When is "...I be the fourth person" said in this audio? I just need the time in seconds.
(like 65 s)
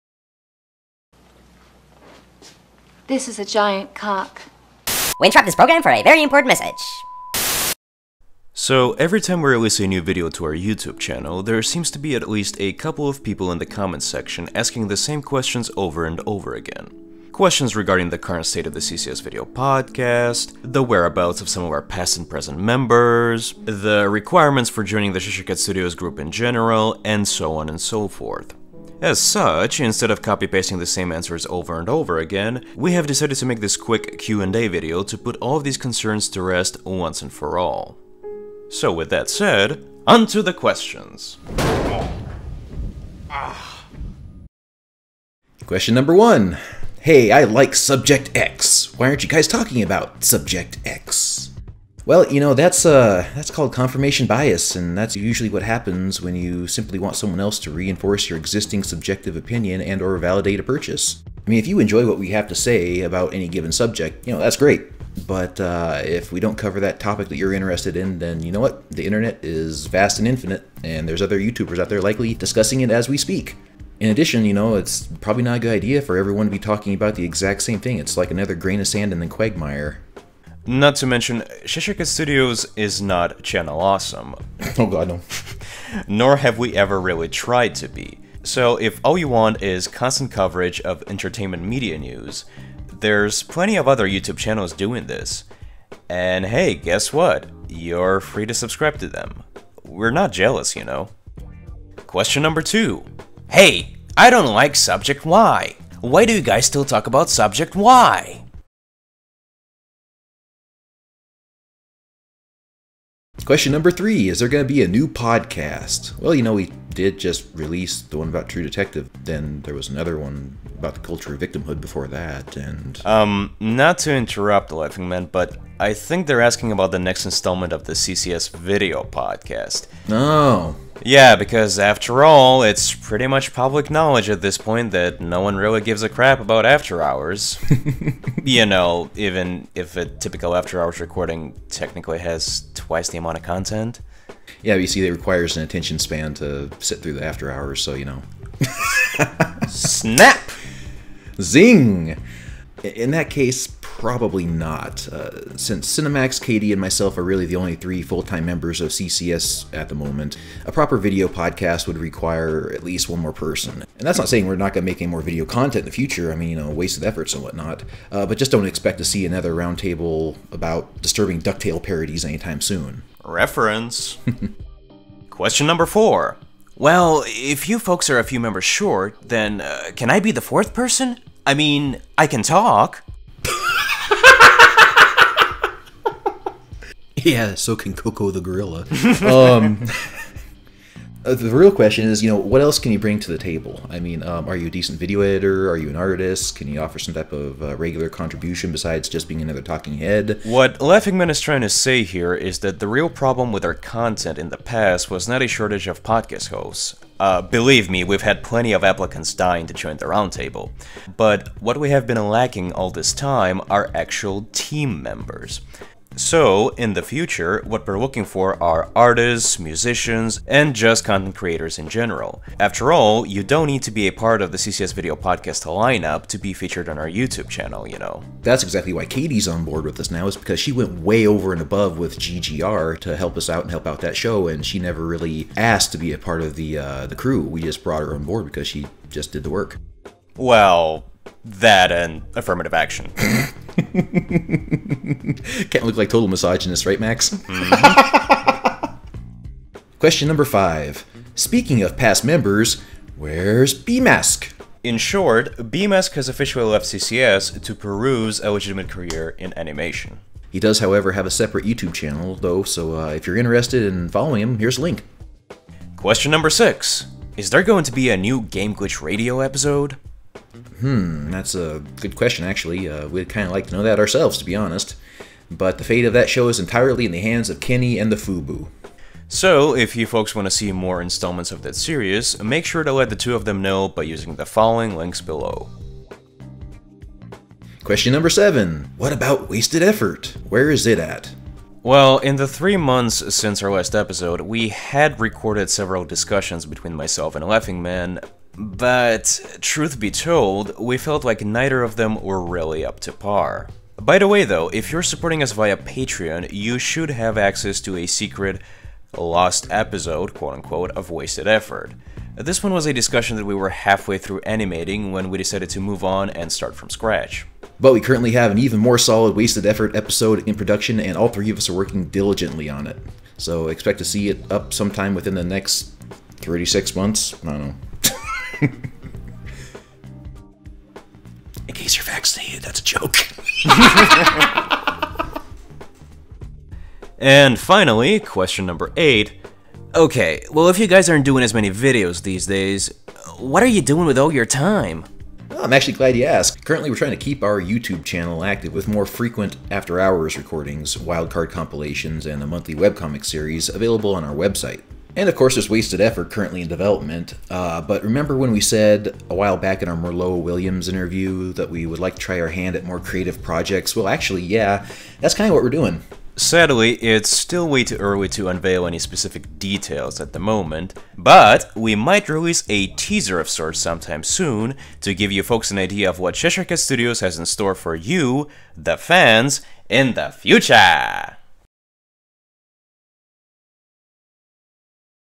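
180 s.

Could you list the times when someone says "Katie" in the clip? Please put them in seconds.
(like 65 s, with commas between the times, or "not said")
156 s, 229 s.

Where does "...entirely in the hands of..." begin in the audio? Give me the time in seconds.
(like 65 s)
276 s.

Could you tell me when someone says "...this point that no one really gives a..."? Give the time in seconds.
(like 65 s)
134 s.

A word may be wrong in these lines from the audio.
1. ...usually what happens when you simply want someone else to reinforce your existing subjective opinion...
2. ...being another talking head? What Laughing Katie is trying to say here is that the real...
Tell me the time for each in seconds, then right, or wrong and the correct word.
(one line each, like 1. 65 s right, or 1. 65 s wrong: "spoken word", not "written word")
1. 55 s right
2. 199 s wrong: "Man", not "Katie".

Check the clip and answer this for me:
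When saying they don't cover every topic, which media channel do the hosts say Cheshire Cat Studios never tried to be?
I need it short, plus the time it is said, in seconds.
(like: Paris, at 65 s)
Channel Awesome, at 83 s.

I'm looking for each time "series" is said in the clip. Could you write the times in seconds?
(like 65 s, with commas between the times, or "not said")
281 s, 353 s.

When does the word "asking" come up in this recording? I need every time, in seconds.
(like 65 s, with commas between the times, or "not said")
14 s, 126 s.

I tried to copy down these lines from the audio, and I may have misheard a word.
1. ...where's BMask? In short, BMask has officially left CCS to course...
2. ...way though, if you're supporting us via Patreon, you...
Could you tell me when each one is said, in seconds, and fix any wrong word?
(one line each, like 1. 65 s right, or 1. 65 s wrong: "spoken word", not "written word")
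1. 253 s wrong: "peruse", not "course"
2. 304 s right.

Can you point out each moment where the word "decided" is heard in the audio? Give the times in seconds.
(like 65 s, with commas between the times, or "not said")
33 s, 315 s.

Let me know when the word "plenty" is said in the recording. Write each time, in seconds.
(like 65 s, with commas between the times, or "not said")
93 s, 208 s.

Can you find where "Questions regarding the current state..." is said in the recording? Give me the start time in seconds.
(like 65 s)
17 s.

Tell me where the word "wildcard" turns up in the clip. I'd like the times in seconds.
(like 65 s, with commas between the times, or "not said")
350 s.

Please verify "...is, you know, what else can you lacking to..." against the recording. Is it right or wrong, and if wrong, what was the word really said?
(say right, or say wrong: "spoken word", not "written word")
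wrong: "bring", not "lacking".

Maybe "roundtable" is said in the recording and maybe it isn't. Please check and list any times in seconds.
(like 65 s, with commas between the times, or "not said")
169 s, 210 s.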